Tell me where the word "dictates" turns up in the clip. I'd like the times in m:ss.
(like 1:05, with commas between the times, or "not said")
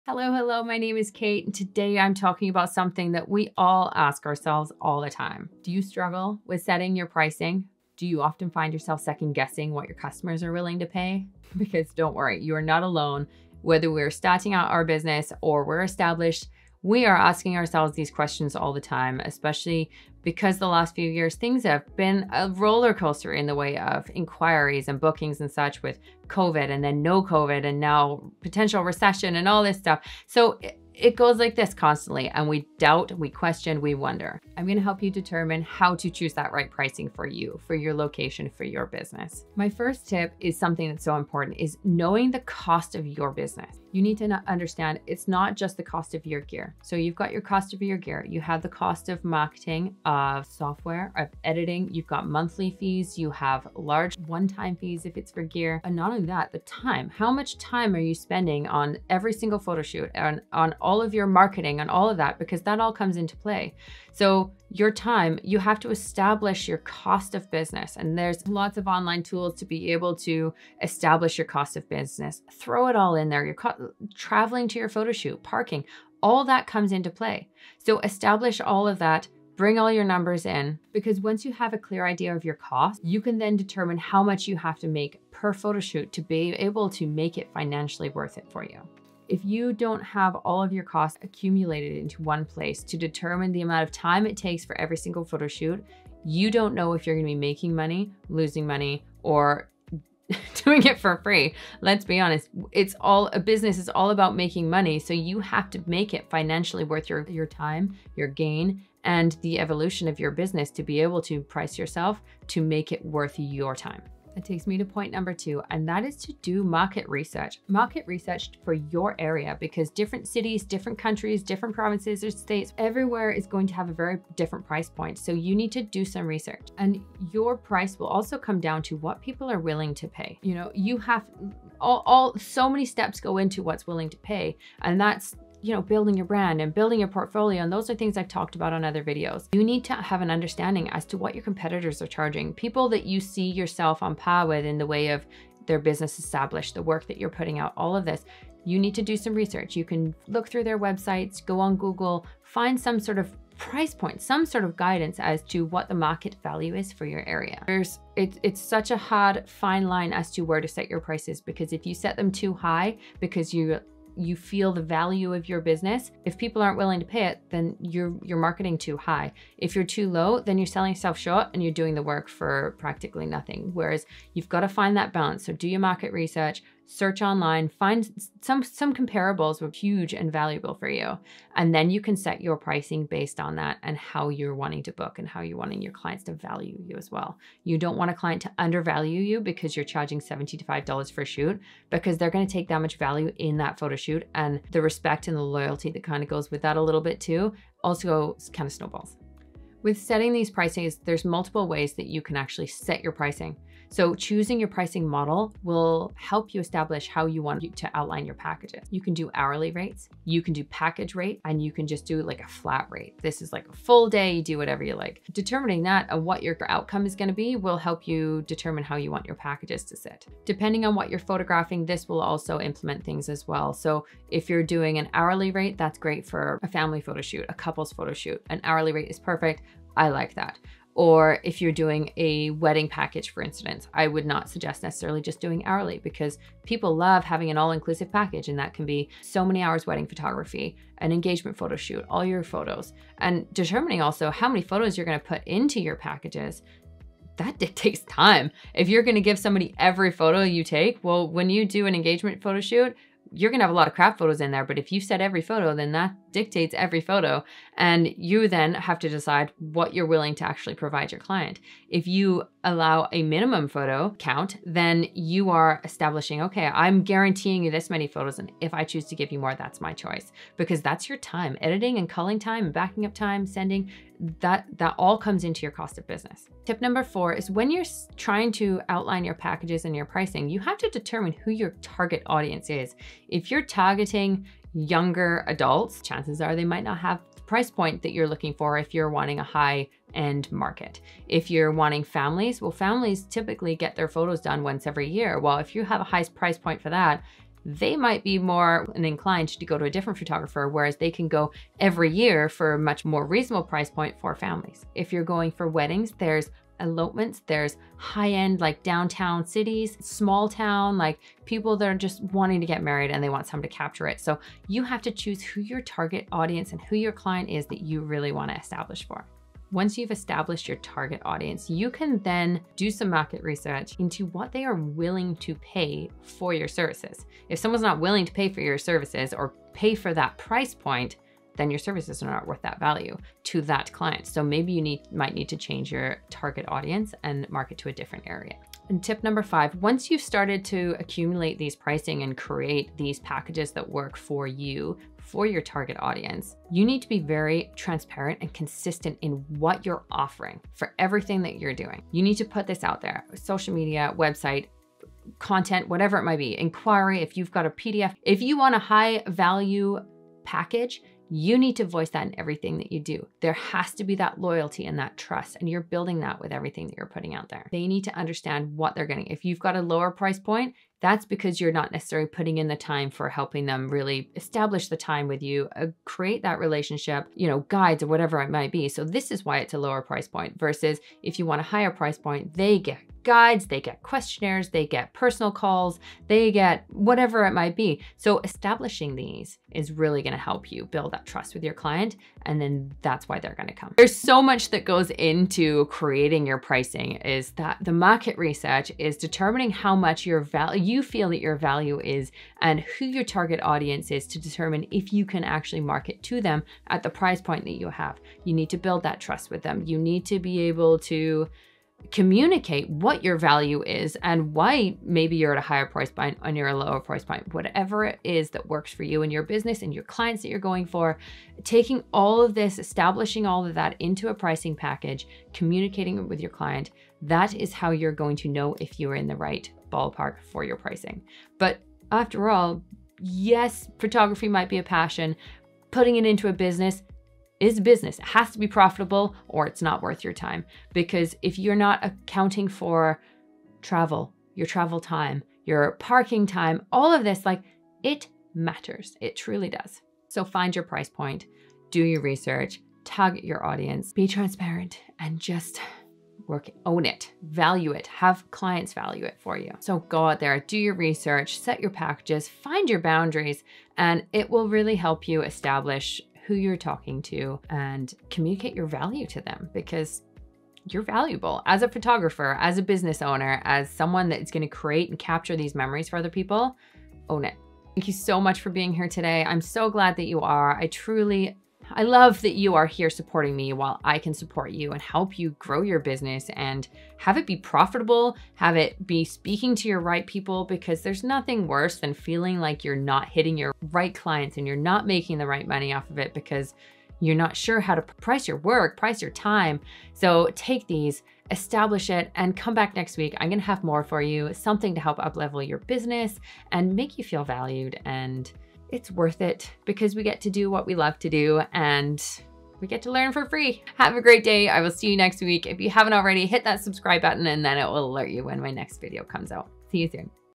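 4:07, 4:16.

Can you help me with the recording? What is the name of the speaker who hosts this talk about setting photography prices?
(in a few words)
Kate.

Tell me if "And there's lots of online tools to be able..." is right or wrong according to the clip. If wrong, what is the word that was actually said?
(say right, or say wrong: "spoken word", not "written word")
right.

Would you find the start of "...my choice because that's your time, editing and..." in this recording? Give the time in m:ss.
4:29.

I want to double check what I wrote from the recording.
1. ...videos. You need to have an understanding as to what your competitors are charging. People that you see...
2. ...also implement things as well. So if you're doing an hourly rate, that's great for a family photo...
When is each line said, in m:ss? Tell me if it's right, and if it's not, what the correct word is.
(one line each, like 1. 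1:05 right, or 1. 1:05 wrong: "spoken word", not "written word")
1. 2:19 right
2. 3:42 right.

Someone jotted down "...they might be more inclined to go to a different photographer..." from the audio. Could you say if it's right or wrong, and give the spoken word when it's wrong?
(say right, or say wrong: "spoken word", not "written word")
right.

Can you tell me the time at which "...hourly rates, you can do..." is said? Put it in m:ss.
3:29.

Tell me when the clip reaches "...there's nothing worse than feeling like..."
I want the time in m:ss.
8:11.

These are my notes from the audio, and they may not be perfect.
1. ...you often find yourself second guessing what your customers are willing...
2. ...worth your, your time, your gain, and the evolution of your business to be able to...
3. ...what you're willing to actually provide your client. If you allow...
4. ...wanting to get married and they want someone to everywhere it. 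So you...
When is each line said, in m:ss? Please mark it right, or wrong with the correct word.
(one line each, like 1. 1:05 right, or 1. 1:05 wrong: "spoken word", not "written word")
1. 0:08 right
2. 1:46 right
3. 4:19 right
4. 5:12 wrong: "capture", not "everywhere".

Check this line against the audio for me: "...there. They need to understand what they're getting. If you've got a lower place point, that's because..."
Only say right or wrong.
wrong.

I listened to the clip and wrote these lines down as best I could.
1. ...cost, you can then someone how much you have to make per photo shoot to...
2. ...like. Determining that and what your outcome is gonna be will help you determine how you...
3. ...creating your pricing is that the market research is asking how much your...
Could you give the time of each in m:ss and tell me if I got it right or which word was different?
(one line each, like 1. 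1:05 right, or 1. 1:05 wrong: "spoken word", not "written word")
1. 1:22 wrong: "determine", not "someone"
2. 3:34 right
3. 6:35 wrong: "determining", not "asking".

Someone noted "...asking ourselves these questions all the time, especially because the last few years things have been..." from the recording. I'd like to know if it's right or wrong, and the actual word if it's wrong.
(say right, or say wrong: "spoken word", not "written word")
right.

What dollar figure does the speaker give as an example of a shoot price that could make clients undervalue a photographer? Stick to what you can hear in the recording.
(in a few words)
$75.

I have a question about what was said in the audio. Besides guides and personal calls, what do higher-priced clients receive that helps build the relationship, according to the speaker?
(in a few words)
questionnaires.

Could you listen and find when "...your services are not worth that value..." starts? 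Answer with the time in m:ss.
5:31.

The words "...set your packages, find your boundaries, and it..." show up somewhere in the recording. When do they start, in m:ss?
7:41.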